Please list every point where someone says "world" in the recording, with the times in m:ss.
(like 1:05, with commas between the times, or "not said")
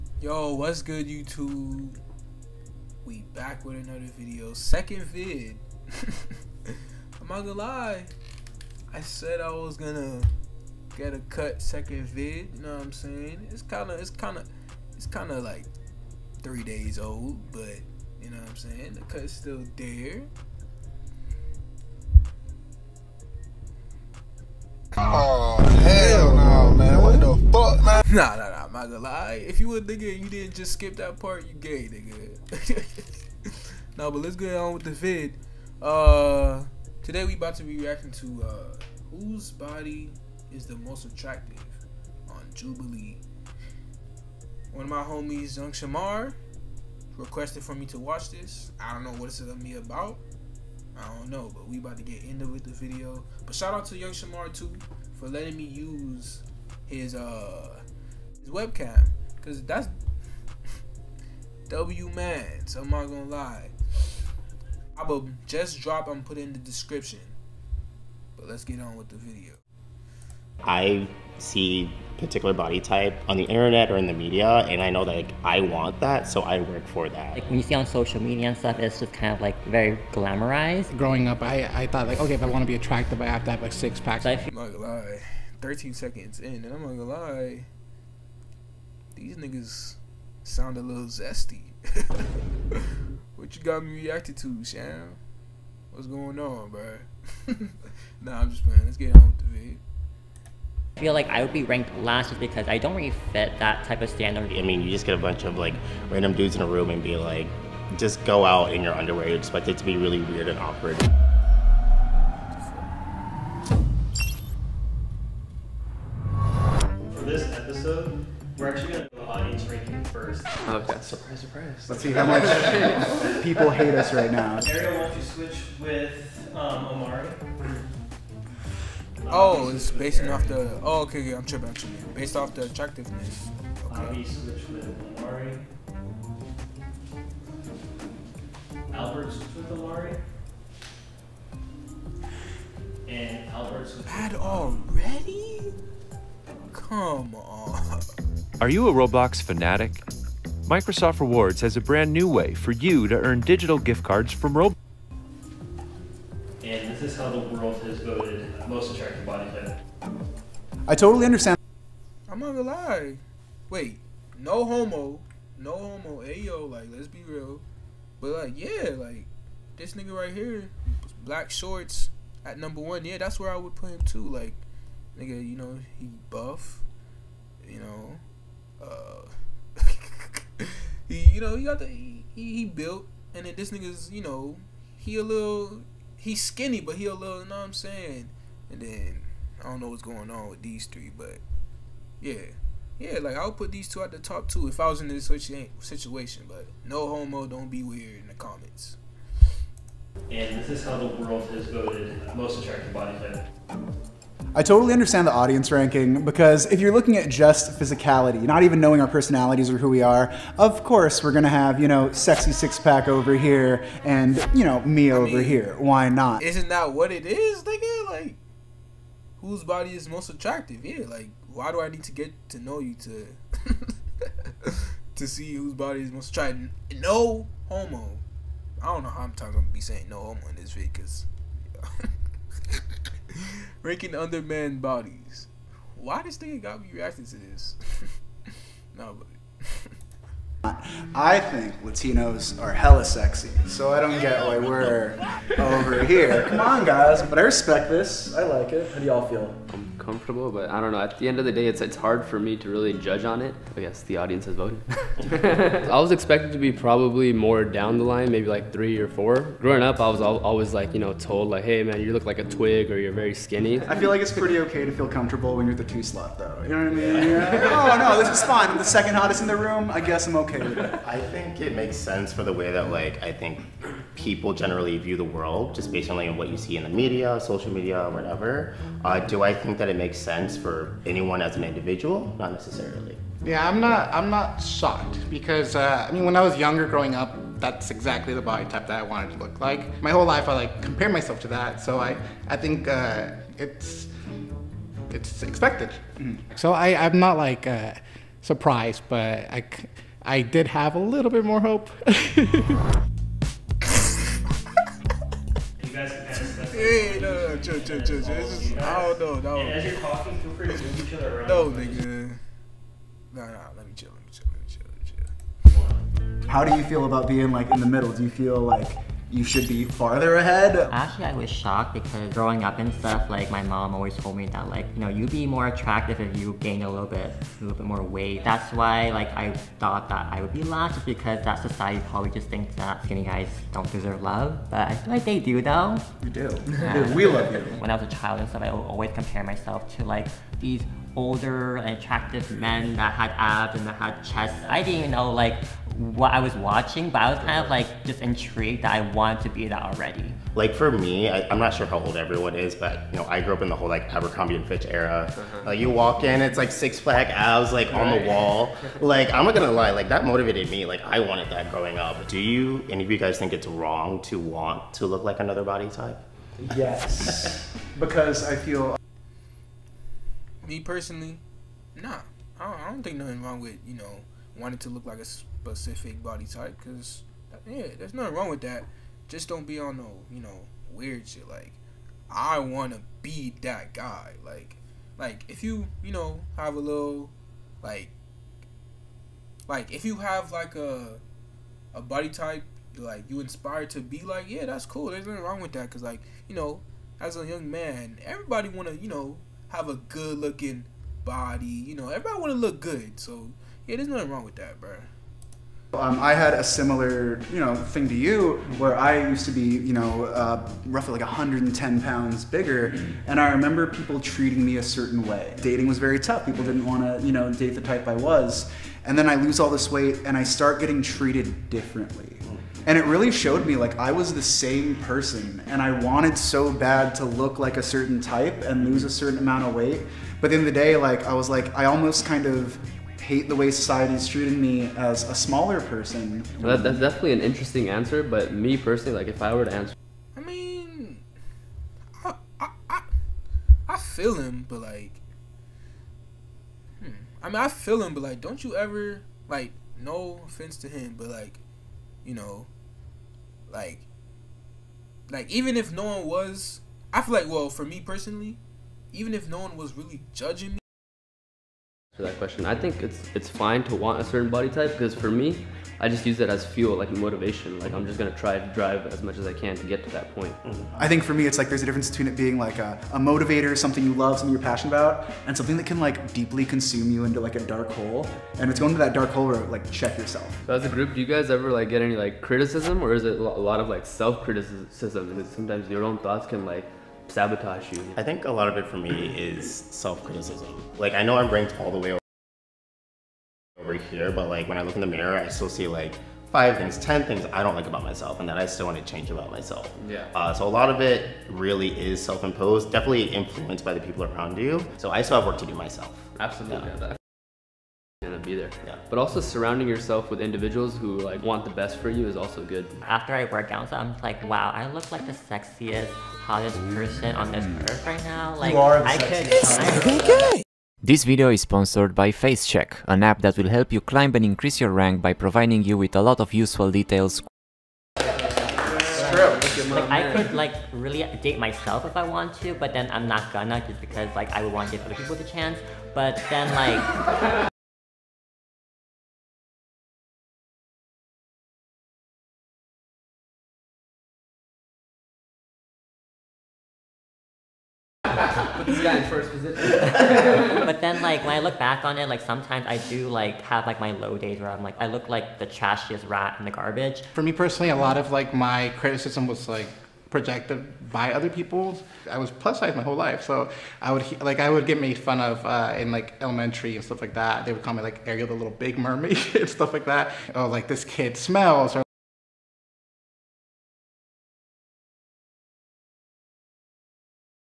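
2:37, 3:21, 4:35.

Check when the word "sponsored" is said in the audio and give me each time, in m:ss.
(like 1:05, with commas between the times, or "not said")
8:41.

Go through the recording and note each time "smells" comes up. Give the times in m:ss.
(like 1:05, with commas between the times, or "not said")
9:31.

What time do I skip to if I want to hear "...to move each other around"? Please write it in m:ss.
5:10.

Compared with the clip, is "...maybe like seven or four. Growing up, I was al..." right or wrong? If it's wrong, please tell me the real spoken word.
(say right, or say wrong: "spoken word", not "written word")
wrong: "three", not "seven".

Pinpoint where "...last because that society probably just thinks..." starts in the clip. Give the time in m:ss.
5:30.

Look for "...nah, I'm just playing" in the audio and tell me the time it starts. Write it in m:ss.
1:38.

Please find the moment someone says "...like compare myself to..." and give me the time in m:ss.
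4:50.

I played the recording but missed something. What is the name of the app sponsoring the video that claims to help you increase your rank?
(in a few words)
FaceCheck.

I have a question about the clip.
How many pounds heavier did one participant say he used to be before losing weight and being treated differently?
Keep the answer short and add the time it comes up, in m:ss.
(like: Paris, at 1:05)
110, at 6:51.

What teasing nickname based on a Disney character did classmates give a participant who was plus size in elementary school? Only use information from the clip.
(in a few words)
Ariel the Little Big Mermaid.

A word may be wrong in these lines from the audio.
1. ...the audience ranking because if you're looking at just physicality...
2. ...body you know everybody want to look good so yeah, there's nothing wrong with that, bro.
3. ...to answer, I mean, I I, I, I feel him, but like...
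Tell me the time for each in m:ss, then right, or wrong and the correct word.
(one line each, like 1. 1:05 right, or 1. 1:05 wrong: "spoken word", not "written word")
1. 3:25 right
2. 6:41 right
3. 7:19 right.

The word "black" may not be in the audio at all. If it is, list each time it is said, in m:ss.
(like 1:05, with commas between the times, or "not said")
2:51.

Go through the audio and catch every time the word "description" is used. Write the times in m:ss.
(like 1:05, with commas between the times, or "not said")
1:06.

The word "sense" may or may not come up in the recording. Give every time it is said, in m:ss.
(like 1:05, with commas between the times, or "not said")
4:31, 4:40.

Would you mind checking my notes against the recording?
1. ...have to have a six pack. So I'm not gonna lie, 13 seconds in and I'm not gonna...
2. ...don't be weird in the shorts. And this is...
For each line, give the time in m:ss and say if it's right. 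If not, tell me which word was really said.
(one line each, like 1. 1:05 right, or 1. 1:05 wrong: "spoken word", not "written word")
1. 1:23 right
2. 3:17 wrong: "comments", not "shorts".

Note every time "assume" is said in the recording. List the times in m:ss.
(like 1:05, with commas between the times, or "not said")
not said.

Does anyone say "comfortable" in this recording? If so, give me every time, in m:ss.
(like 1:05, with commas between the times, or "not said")
4:10, 4:25.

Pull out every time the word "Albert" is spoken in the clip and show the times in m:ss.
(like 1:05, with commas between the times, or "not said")
2:18, 2:23.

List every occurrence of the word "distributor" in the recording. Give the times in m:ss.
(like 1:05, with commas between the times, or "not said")
not said.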